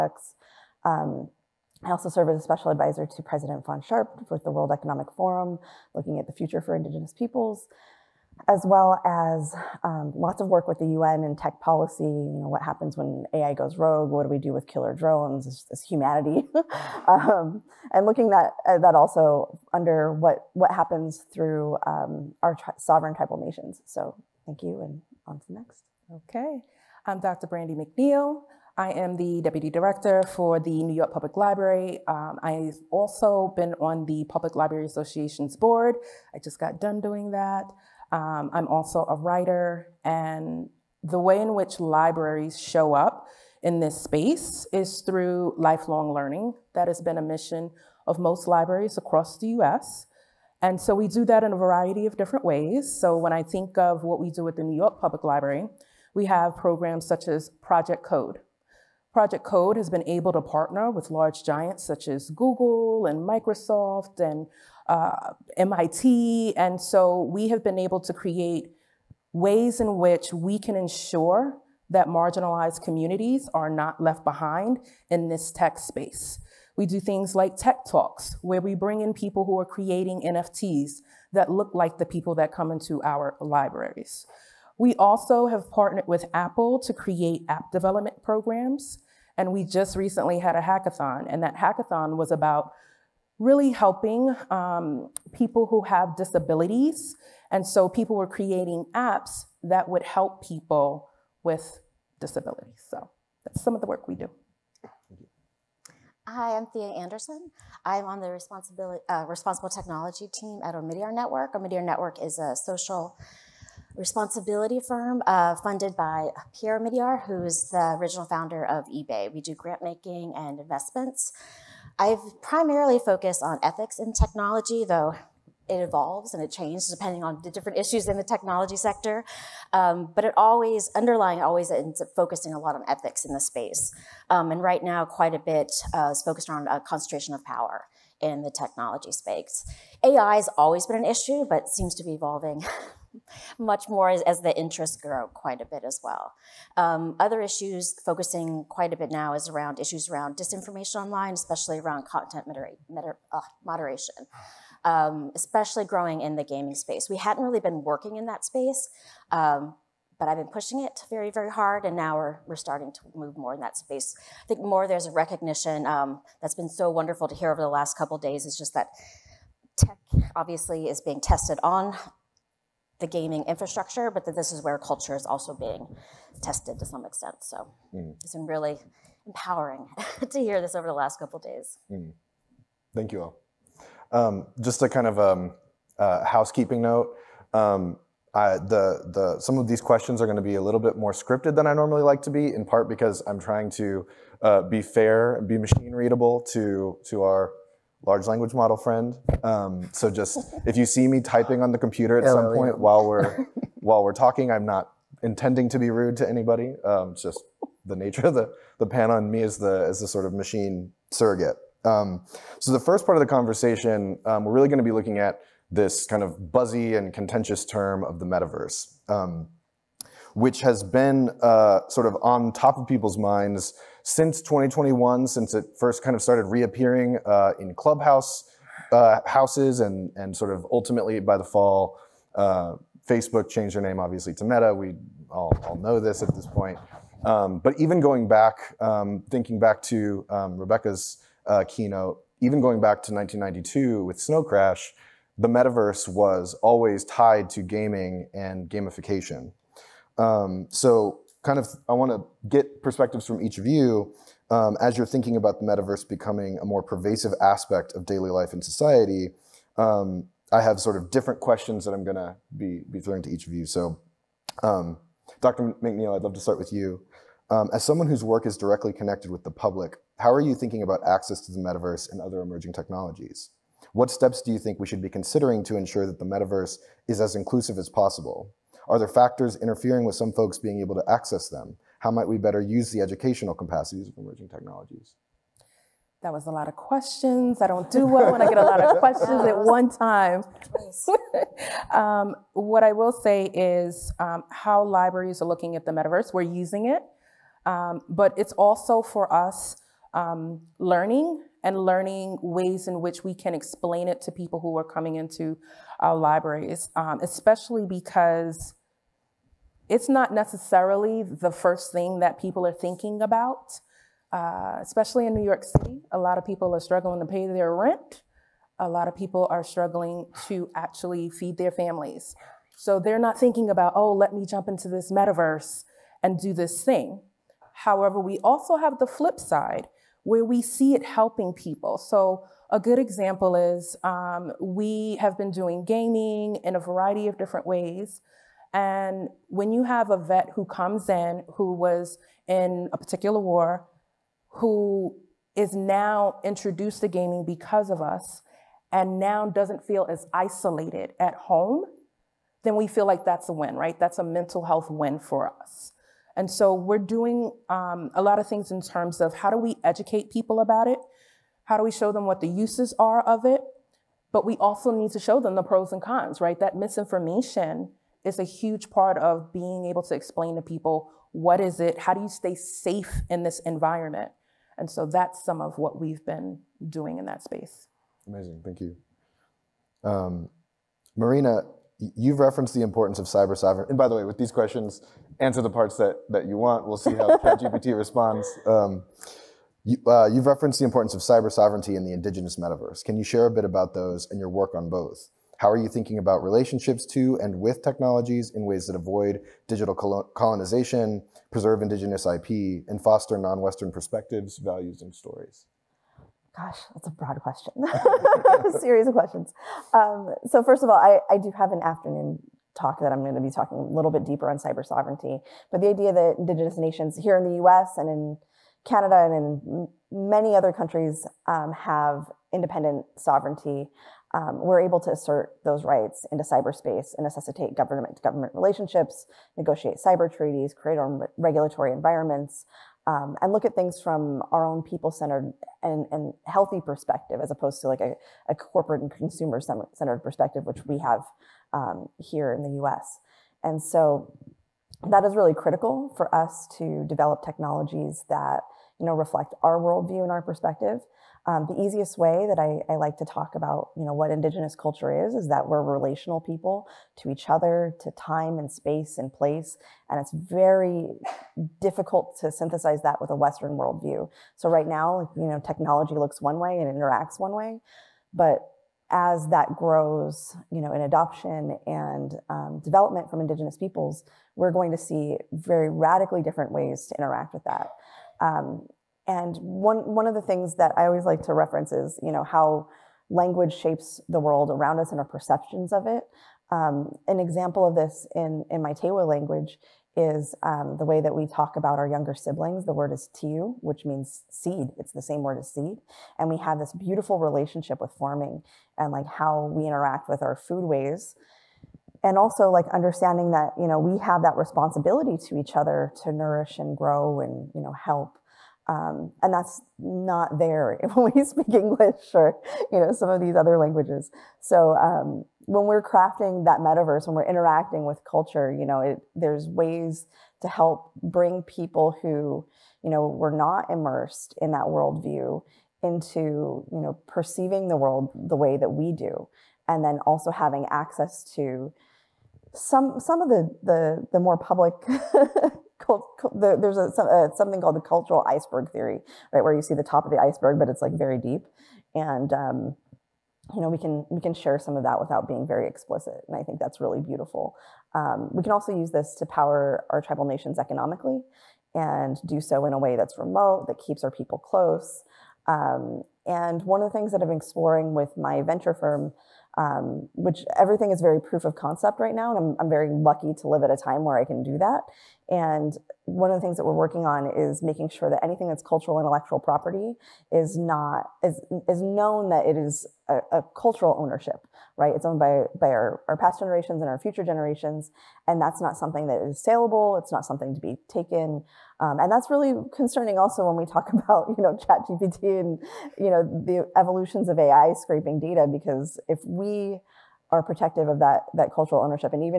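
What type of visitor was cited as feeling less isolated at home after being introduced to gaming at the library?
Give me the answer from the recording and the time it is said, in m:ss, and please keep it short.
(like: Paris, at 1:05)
a vet, at 5:40.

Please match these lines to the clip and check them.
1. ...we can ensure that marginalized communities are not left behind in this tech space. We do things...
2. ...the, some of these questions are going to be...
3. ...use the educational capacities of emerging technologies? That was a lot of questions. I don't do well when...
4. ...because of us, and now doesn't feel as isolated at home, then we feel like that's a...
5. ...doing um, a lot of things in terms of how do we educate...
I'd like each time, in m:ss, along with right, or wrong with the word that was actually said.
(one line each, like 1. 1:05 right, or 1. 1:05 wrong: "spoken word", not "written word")
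1. 1:10 right
2. 3:09 right
3. 4:42 right
4. 5:47 right
5. 5:56 right.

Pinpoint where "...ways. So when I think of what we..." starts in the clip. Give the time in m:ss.
0:52.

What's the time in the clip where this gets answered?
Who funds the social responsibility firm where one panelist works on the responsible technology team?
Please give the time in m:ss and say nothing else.
1:56.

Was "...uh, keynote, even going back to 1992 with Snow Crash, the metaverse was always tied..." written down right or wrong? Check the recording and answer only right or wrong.
right.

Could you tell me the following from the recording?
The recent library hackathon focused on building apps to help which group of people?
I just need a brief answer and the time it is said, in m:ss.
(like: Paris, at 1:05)
people who have disabilities, at 1:35.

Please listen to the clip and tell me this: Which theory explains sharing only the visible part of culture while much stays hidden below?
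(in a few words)
cultural iceberg theory.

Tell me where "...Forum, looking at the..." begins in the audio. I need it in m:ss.
0:05.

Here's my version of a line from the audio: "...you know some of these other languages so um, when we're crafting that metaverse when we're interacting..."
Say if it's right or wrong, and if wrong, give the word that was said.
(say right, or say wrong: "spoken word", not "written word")
right.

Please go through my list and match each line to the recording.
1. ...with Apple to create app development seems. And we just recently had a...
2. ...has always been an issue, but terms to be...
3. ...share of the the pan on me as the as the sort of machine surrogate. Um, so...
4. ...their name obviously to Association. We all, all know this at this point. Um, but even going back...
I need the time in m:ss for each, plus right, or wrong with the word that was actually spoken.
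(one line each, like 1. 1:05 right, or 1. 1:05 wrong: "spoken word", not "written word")
1. 1:26 wrong: "programs", not "seems"
2. 2:20 wrong: "seems", not "terms"
3. 3:27 wrong: "nature", not "share"
4. 3:53 wrong: "Meta", not "Association".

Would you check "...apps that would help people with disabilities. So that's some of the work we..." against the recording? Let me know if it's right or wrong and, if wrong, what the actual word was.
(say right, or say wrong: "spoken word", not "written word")
right.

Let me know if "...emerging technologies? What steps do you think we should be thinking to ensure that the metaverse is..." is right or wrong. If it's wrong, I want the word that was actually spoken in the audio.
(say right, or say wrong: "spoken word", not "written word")
wrong: "considering", not "thinking".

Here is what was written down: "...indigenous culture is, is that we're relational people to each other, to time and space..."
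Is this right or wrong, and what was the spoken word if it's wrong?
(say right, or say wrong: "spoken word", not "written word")
right.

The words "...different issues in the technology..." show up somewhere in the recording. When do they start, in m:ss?
2:07.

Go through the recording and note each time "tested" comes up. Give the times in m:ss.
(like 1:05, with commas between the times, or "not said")
2:51, 2:56.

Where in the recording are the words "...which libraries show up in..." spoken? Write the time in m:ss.
0:41.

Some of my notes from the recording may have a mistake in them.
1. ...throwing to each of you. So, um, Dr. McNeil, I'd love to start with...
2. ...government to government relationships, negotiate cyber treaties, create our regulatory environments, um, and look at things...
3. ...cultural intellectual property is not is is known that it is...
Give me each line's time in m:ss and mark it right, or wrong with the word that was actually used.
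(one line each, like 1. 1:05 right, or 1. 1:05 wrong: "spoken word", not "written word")
1. 4:22 right
2. 7:07 right
3. 9:28 right.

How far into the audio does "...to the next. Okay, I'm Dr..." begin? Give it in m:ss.
0:25.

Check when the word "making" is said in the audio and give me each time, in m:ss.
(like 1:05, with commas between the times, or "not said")
1:59, 9:27.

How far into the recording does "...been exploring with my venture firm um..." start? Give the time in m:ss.
9:17.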